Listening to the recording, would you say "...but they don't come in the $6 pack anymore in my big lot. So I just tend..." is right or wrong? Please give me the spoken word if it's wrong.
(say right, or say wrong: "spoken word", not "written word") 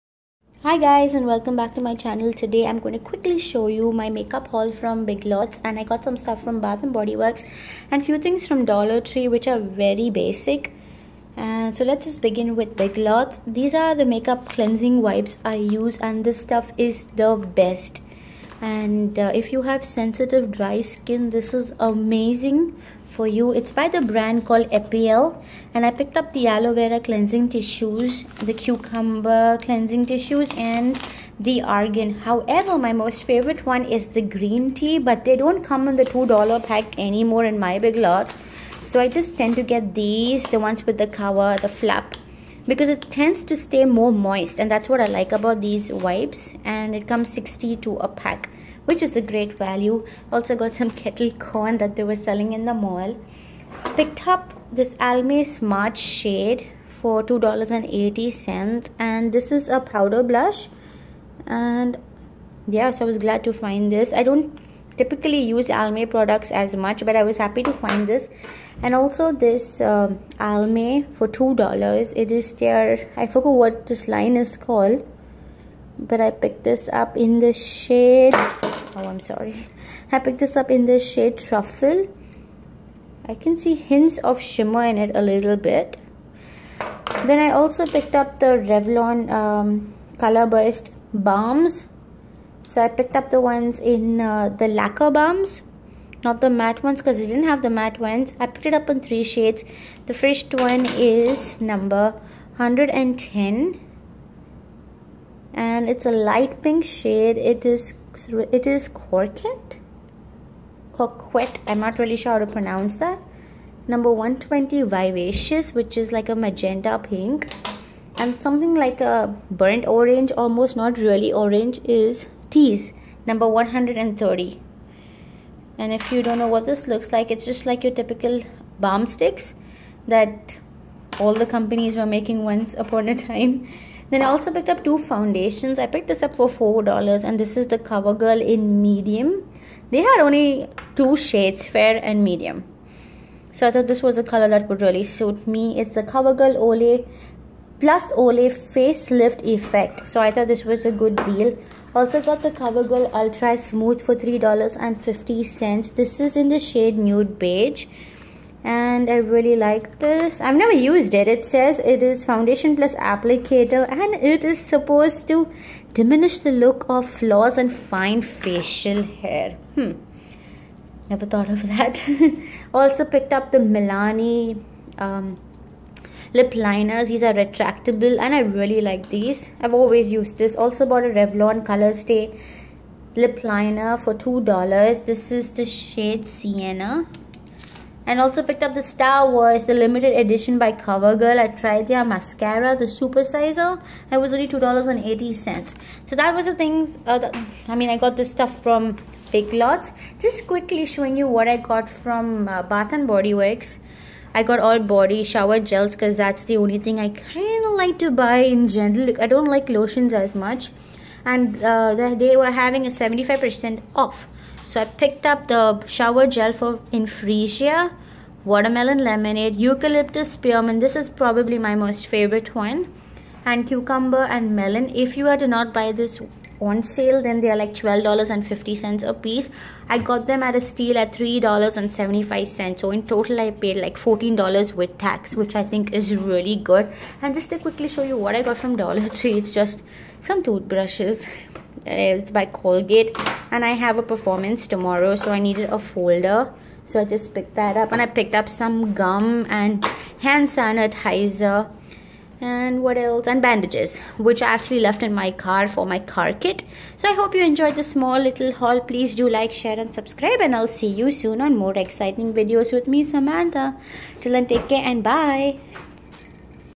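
wrong: "2", not "6".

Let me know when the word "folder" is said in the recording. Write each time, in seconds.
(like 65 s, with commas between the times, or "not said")
245 s.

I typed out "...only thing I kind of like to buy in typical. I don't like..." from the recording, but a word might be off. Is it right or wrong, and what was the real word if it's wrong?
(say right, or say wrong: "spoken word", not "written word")
wrong: "general", not "typical".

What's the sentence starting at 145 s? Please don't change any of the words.
It's the CoverGirl Olay plus Olay facelift effect.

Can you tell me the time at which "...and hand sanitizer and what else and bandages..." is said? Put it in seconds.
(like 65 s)
249 s.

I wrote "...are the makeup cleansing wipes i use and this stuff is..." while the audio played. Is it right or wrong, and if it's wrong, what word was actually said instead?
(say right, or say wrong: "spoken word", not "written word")
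right.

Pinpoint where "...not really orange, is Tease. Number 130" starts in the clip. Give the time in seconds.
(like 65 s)
120 s.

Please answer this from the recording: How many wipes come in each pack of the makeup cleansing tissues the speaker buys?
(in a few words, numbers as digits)
60.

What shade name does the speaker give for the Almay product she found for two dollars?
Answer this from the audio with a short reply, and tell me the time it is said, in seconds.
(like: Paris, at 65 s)
Truffle, at 81 s.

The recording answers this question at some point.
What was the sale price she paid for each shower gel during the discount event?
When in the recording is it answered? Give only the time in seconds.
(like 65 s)
231 s.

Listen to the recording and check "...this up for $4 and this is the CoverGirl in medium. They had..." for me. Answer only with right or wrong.
right.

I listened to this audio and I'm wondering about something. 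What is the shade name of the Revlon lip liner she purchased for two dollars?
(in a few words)
Sienna.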